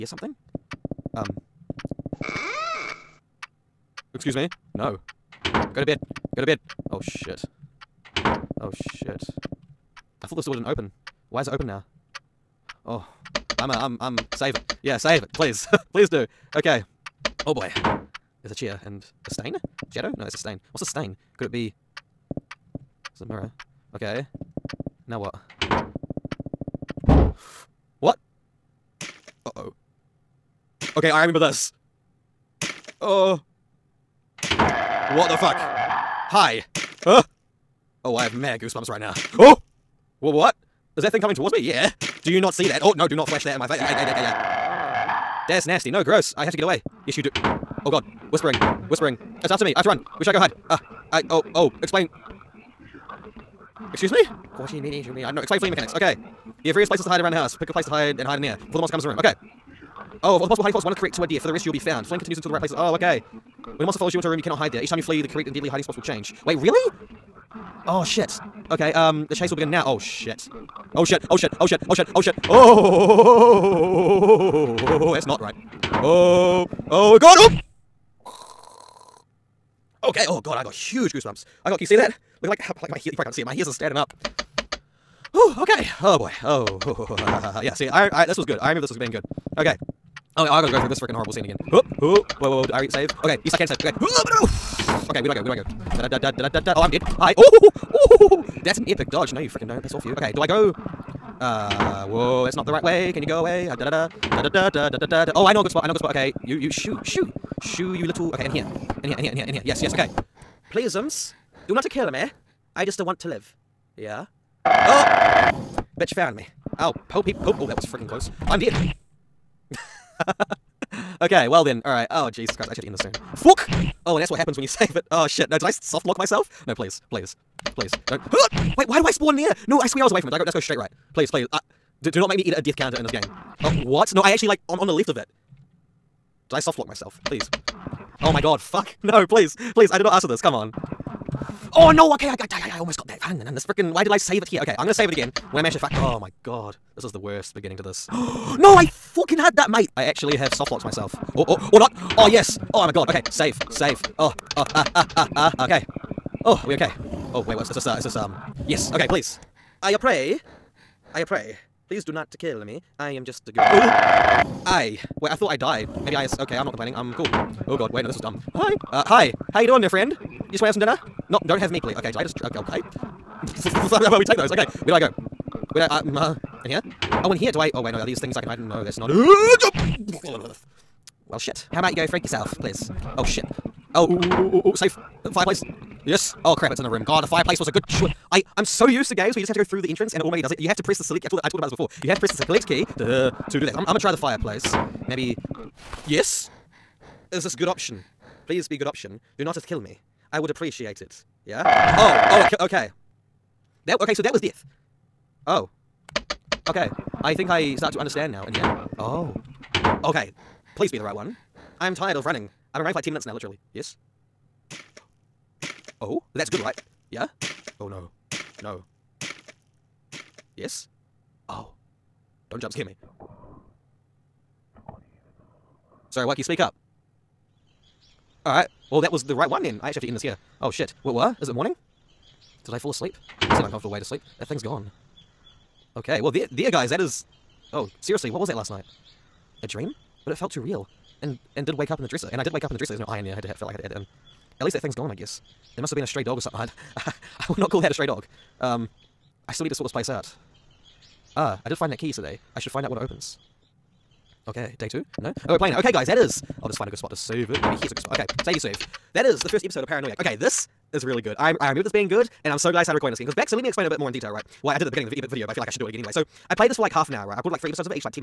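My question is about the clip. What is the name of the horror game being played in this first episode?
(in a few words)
Paranoiac.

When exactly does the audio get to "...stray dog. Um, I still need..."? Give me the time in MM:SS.
04:07.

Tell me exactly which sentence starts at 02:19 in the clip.
Please, I did not ask for this.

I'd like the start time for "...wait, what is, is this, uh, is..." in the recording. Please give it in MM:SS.
02:37.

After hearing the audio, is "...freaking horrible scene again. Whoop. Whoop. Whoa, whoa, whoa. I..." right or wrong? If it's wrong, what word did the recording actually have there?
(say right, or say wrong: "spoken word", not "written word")
right.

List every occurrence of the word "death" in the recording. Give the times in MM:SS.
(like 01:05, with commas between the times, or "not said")
02:12, 03:24.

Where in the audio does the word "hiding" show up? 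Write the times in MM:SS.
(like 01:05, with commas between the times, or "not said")
01:00, 01:05.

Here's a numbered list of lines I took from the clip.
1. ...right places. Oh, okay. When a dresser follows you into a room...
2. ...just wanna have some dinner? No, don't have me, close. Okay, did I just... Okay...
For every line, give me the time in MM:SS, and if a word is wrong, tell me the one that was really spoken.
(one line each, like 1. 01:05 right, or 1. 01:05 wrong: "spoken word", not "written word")
1. 01:02 wrong: "monster", not "dresser"
2. 02:50 wrong: "please", not "close".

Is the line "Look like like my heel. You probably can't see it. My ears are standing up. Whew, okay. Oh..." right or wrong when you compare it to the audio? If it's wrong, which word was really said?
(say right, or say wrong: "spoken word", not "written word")
right.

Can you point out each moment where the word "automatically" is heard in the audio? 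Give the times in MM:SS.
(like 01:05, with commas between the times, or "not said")
03:10.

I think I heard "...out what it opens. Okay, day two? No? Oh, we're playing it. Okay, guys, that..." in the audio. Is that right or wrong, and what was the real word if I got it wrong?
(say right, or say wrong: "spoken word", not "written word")
right.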